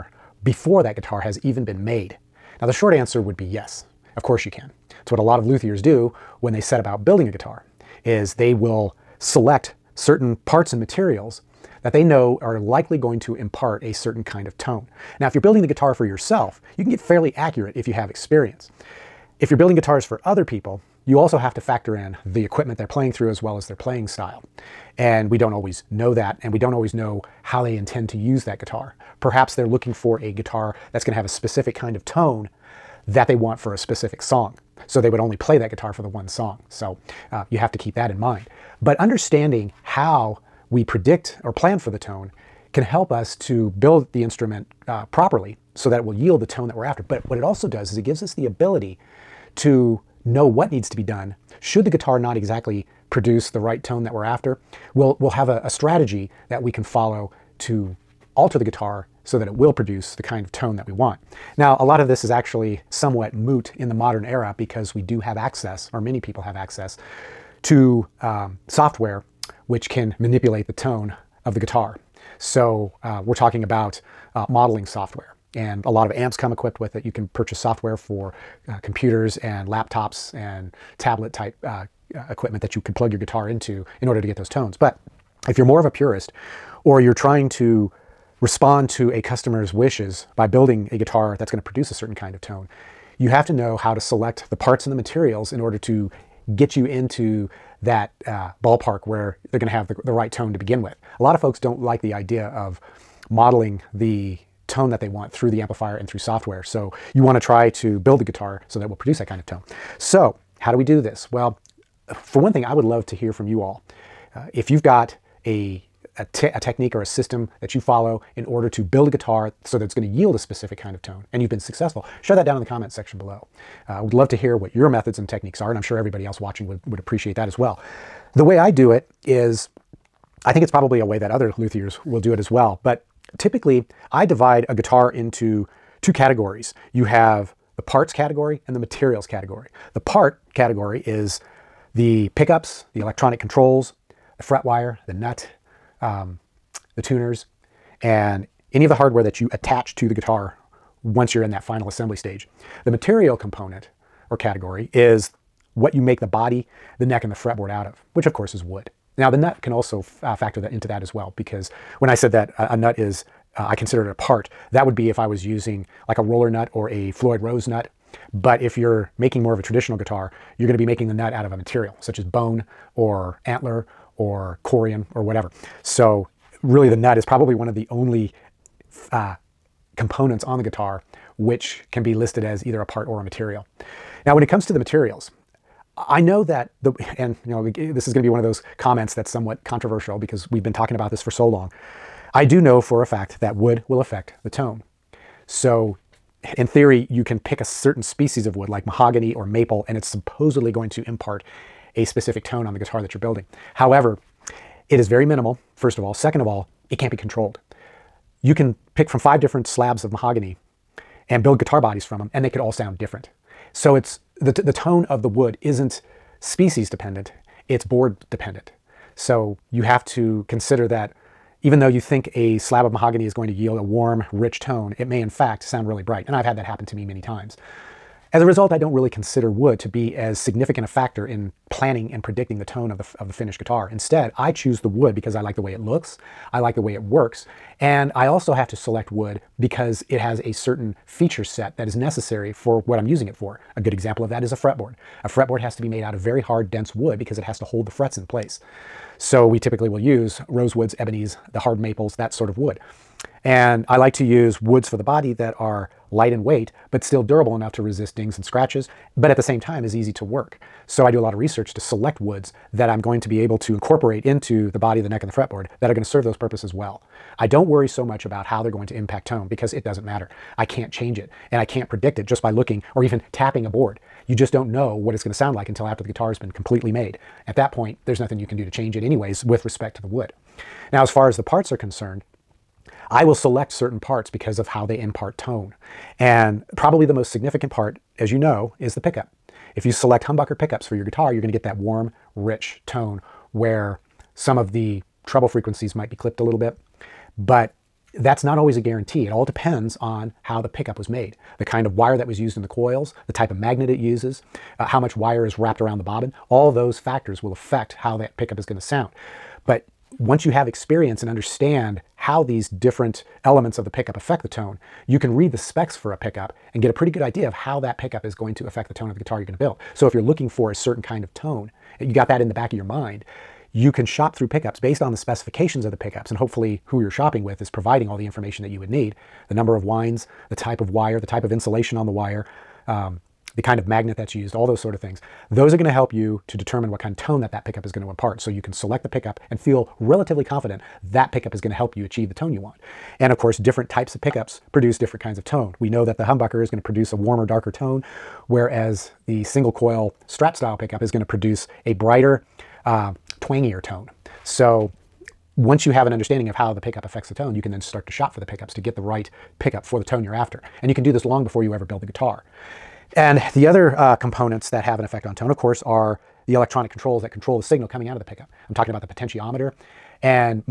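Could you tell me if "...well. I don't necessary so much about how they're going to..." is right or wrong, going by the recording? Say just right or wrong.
wrong.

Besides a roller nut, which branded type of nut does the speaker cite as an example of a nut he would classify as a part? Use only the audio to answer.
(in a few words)
Floyd Rose.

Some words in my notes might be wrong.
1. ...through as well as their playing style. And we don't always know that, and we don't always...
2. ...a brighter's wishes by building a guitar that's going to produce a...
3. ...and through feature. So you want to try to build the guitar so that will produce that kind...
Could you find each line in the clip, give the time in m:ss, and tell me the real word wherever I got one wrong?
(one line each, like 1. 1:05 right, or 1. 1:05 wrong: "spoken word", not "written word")
1. 0:23 right
2. 1:29 wrong: "customer", not "brighter"
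3. 1:45 wrong: "software", not "feature".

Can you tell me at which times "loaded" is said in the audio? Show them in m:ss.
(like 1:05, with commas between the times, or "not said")
not said.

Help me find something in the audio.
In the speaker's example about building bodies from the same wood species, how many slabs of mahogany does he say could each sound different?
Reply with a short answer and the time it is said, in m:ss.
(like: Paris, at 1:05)
5, at 3:29.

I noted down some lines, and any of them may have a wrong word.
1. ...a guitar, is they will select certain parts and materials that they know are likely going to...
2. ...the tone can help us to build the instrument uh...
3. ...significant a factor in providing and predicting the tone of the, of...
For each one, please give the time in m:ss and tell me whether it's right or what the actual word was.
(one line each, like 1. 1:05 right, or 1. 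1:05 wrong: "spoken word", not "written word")
1. 0:07 right
2. 0:41 right
3. 3:50 wrong: "planning", not "providing".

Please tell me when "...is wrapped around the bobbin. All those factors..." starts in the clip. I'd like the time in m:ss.
5:05.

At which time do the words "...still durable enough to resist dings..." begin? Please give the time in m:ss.
4:17.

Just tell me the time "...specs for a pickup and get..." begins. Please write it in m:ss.
5:15.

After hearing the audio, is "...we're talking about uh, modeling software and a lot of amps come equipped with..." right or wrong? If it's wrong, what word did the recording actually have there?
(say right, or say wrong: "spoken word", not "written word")
right.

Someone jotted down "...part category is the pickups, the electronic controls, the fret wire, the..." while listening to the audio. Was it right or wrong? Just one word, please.
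right.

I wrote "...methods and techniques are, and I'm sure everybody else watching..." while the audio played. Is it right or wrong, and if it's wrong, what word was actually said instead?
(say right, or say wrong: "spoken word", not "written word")
right.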